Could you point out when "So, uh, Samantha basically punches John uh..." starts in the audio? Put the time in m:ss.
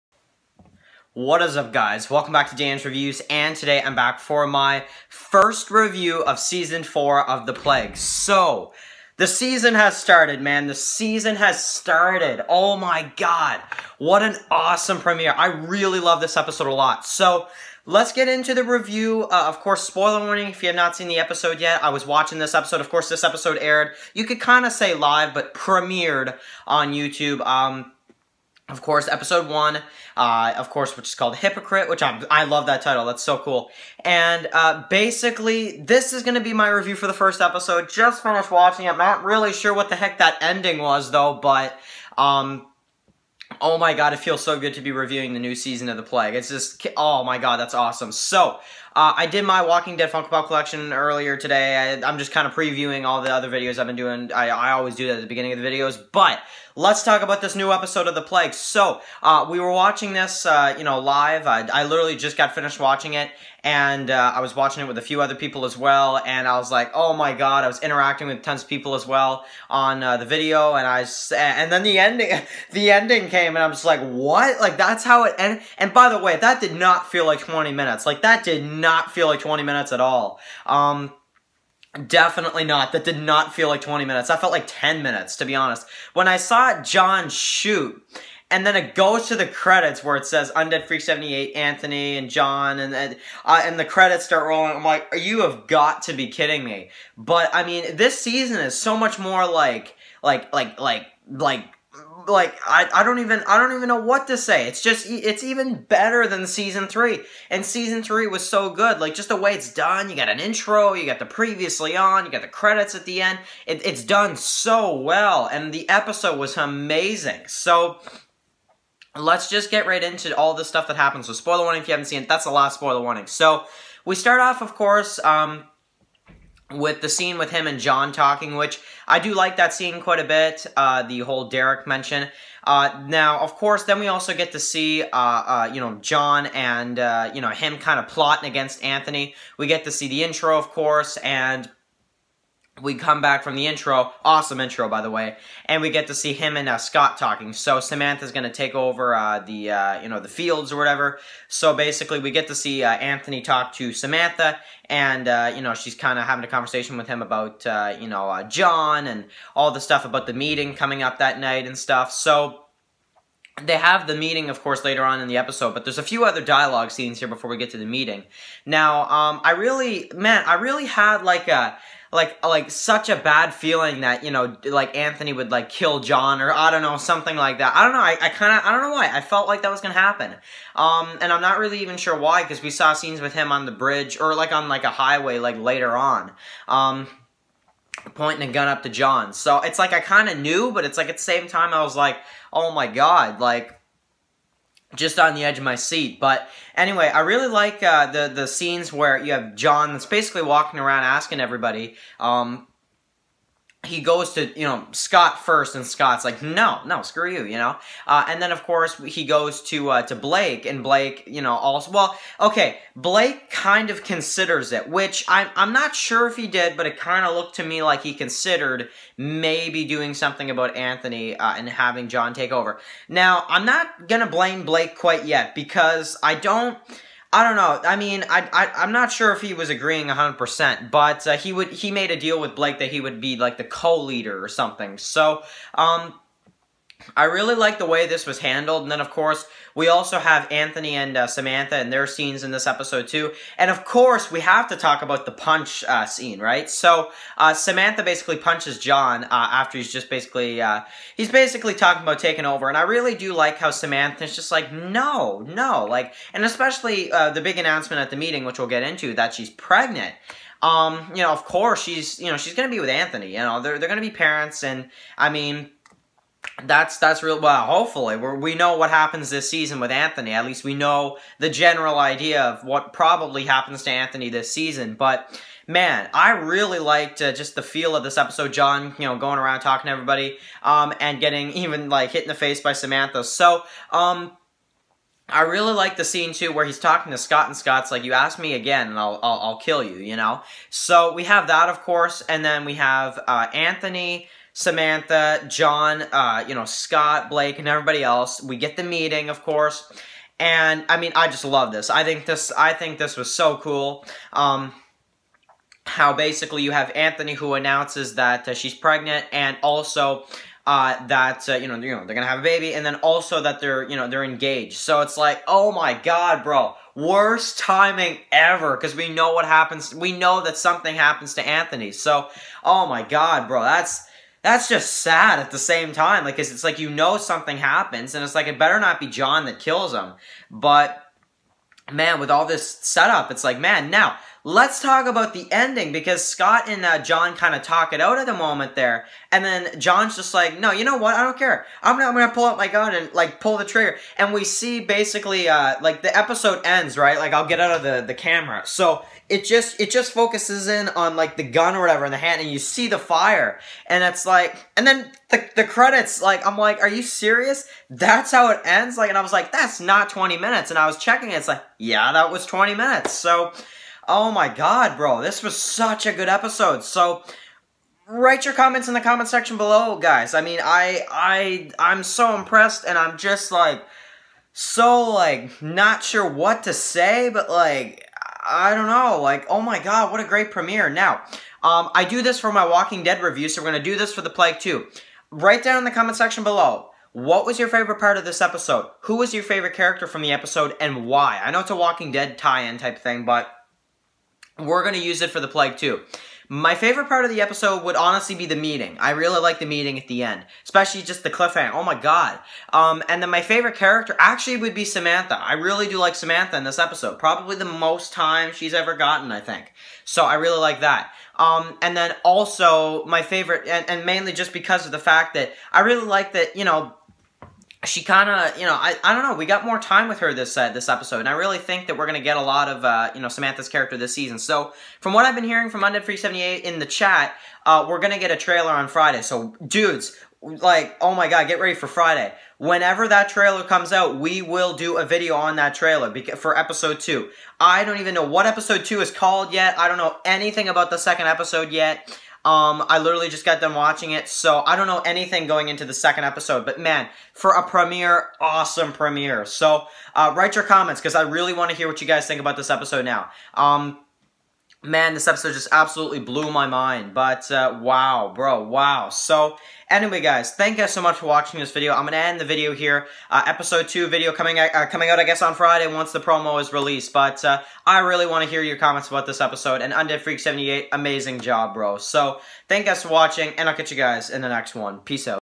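4:06.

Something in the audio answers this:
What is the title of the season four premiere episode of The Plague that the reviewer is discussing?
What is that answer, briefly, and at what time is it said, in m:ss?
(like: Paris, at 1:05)
Hypocrite, at 0:31.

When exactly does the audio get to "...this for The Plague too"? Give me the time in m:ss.
6:23.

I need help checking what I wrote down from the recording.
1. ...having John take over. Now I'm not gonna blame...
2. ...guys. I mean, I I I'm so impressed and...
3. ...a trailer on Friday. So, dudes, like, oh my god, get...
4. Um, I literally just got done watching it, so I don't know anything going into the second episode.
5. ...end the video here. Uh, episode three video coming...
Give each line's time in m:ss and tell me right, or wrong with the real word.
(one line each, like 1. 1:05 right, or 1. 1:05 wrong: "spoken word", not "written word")
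1. 3:41 right
2. 6:09 right
3. 7:08 right
4. 7:22 right
5. 7:42 wrong: "two", not "three".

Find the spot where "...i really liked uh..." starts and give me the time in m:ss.
4:36.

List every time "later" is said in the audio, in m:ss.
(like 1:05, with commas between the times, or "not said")
2:44, 3:05.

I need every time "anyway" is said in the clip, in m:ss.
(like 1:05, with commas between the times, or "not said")
3:16, 7:39.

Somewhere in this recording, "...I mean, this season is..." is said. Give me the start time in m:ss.
1:37.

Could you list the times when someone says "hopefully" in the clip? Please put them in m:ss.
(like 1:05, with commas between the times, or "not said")
4:27.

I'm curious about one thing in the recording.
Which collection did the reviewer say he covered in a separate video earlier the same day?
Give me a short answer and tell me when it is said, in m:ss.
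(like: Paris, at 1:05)
Walking Dead Funko Pop collection, at 0:49.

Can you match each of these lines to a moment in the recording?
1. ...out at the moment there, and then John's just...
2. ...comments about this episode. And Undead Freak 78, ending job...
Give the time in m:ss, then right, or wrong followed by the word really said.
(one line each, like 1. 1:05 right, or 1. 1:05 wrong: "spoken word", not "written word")
1. 5:38 right
2. 7:48 wrong: "amazing", not "ending".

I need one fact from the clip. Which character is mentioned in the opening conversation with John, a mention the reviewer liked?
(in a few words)
Derek.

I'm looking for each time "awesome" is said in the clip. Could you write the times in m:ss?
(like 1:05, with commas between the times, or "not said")
0:14, 0:47, 2:24, 7:28.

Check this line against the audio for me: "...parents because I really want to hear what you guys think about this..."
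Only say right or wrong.
wrong.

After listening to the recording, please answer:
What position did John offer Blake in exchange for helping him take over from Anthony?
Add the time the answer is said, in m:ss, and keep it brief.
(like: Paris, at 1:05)
co-leader, at 3:53.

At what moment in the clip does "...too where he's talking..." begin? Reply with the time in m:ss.
4:46.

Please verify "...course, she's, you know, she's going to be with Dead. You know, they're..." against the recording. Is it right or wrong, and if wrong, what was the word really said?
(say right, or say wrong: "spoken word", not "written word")
wrong: "Anthony", not "Dead".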